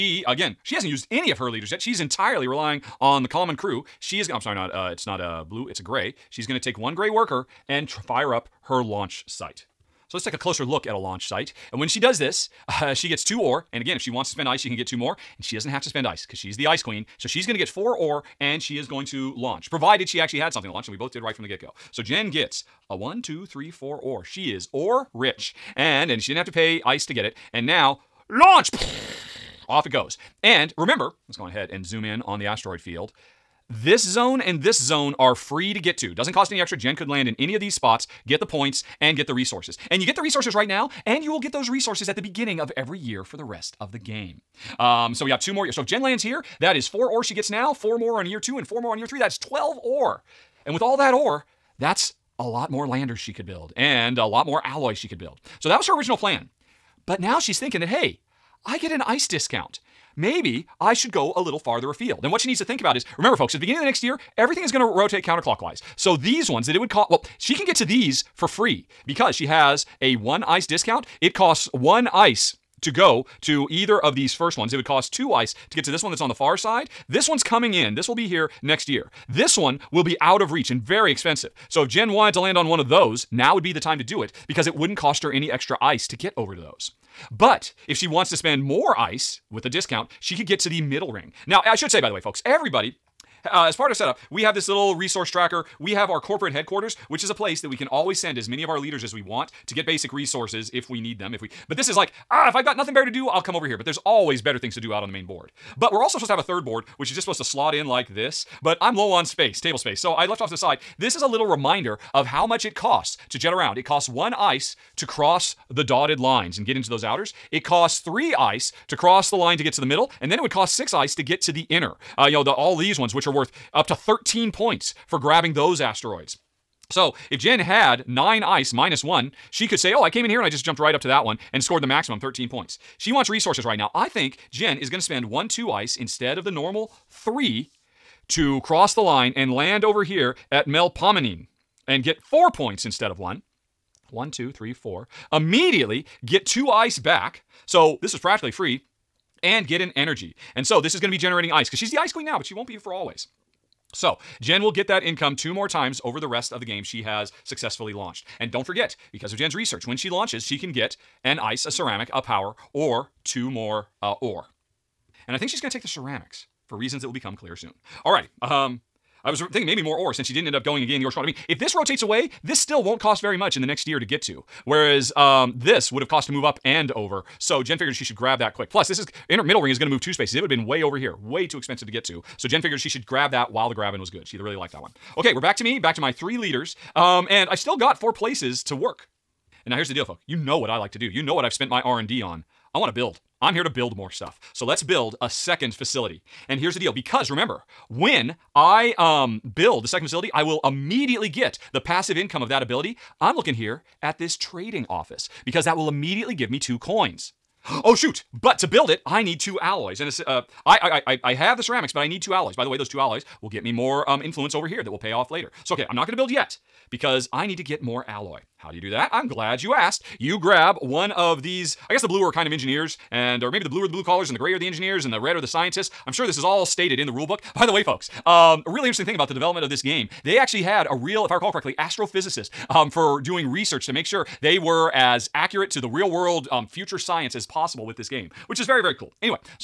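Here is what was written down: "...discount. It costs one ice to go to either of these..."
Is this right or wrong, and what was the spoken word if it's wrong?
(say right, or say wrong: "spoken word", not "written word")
right.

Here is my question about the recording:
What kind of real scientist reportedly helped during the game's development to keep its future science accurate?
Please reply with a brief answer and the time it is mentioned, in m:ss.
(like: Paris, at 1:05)
astrophysicist, at 3:51.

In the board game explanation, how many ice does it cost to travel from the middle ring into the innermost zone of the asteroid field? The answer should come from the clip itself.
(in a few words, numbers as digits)
6.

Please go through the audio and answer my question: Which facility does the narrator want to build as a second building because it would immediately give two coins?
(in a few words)
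trading office.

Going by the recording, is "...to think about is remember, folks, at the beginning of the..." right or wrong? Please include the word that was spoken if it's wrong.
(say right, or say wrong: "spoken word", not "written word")
right.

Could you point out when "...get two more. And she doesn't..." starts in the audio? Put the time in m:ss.
0:14.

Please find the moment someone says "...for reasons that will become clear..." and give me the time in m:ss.
2:46.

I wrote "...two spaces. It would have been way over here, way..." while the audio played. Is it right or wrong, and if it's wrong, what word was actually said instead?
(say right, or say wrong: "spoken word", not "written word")
right.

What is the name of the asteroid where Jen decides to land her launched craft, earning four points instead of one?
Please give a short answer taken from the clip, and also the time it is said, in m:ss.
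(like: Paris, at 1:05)
Melpomenine, at 2:20.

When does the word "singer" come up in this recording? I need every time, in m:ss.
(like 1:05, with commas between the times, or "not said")
not said.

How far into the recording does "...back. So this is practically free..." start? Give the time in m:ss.
2:26.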